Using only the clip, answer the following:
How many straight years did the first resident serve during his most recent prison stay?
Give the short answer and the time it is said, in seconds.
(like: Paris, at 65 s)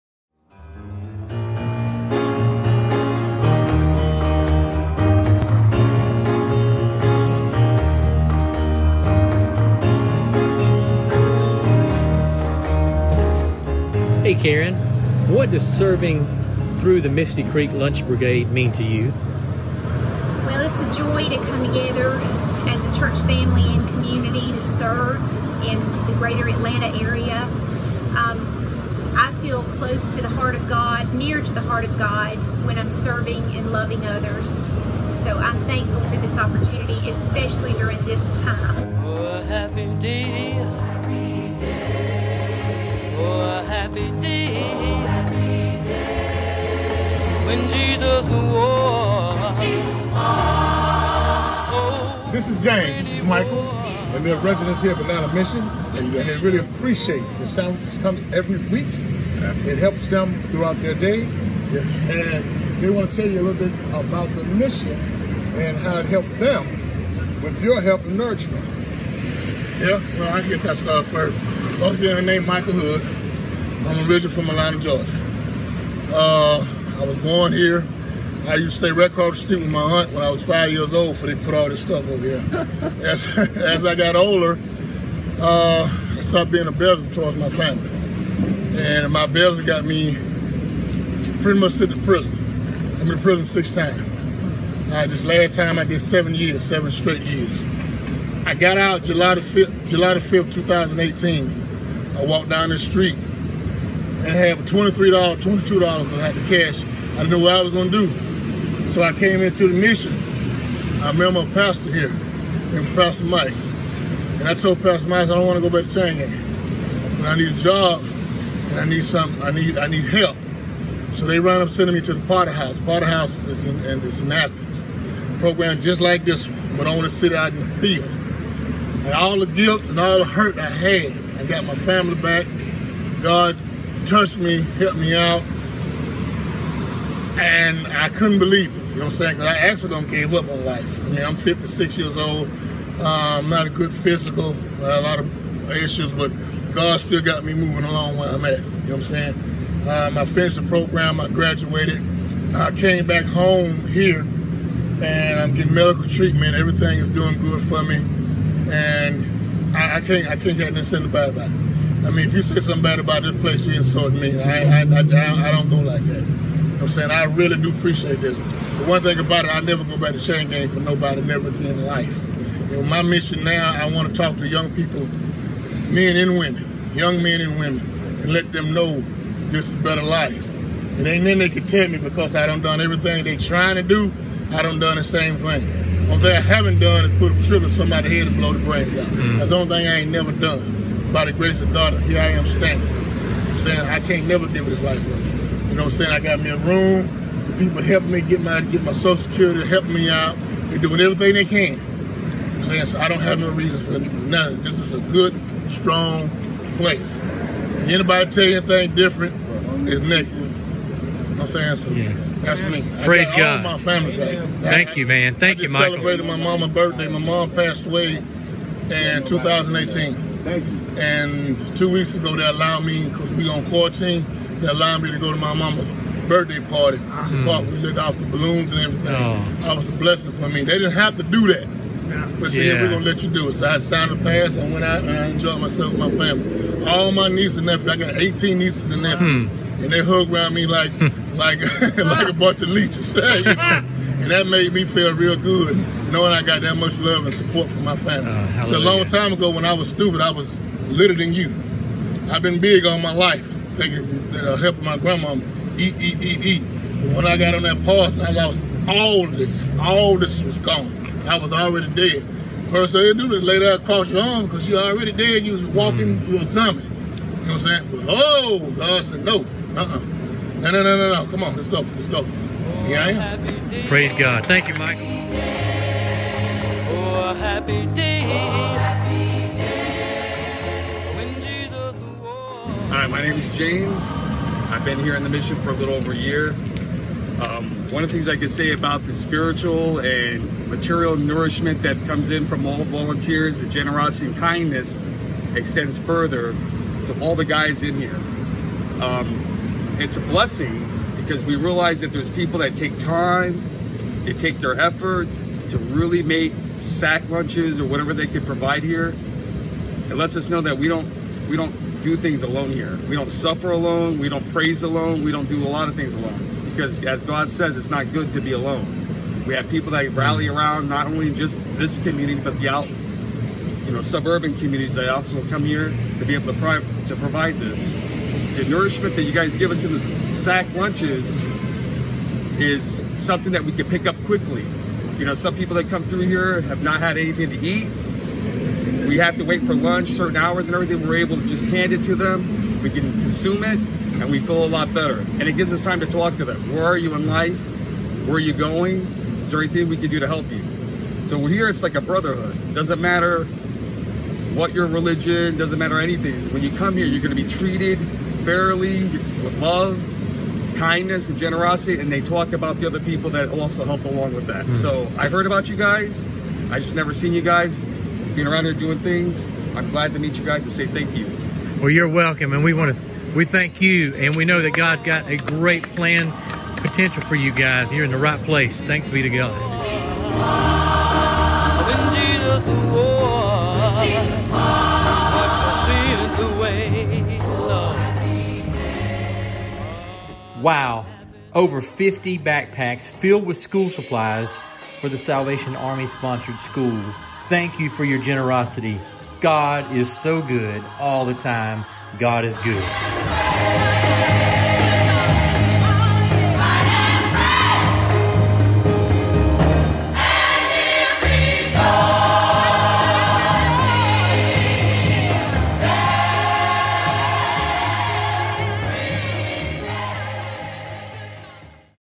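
7, at 96 s.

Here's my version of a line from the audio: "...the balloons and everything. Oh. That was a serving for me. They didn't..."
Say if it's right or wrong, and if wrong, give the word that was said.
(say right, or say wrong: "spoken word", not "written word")
wrong: "blessing", not "serving".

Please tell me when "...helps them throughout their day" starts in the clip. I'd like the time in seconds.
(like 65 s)
59 s.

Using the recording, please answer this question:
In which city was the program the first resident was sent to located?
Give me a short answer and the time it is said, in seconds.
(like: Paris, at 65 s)
Athens, at 124 s.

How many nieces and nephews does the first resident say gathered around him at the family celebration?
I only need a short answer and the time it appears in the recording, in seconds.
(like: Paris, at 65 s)
18, at 238 s.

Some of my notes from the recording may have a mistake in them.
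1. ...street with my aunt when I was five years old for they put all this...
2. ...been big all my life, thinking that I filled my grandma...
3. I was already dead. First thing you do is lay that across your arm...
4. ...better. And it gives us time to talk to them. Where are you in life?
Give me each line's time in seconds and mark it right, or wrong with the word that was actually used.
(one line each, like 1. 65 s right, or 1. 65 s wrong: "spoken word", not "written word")
1. 79 s right
2. 252 s wrong: "helped", not "filled"
3. 261 s right
4. 344 s right.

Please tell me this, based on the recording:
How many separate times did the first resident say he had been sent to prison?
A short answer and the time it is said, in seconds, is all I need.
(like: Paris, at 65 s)
6, at 93 s.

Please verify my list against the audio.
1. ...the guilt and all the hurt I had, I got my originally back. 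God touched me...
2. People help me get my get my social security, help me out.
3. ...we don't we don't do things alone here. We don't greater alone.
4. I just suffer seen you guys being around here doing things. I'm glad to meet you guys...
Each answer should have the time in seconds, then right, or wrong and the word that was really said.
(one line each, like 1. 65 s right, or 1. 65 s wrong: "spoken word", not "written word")
1. 129 s wrong: "family", not "originally"
2. 197 s right
3. 310 s wrong: "suffer", not "greater"
4. 366 s wrong: "never", not "suffer".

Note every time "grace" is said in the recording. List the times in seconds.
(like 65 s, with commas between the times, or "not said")
191 s.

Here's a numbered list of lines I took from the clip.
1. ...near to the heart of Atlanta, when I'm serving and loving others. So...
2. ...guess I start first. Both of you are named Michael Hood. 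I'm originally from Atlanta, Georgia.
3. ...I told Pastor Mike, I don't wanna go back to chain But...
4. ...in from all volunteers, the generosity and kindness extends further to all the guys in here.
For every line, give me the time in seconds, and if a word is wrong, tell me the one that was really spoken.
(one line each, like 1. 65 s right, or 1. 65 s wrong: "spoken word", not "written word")
1. 31 s wrong: "God", not "Atlanta"
2. 70 s right
3. 114 s right
4. 292 s right.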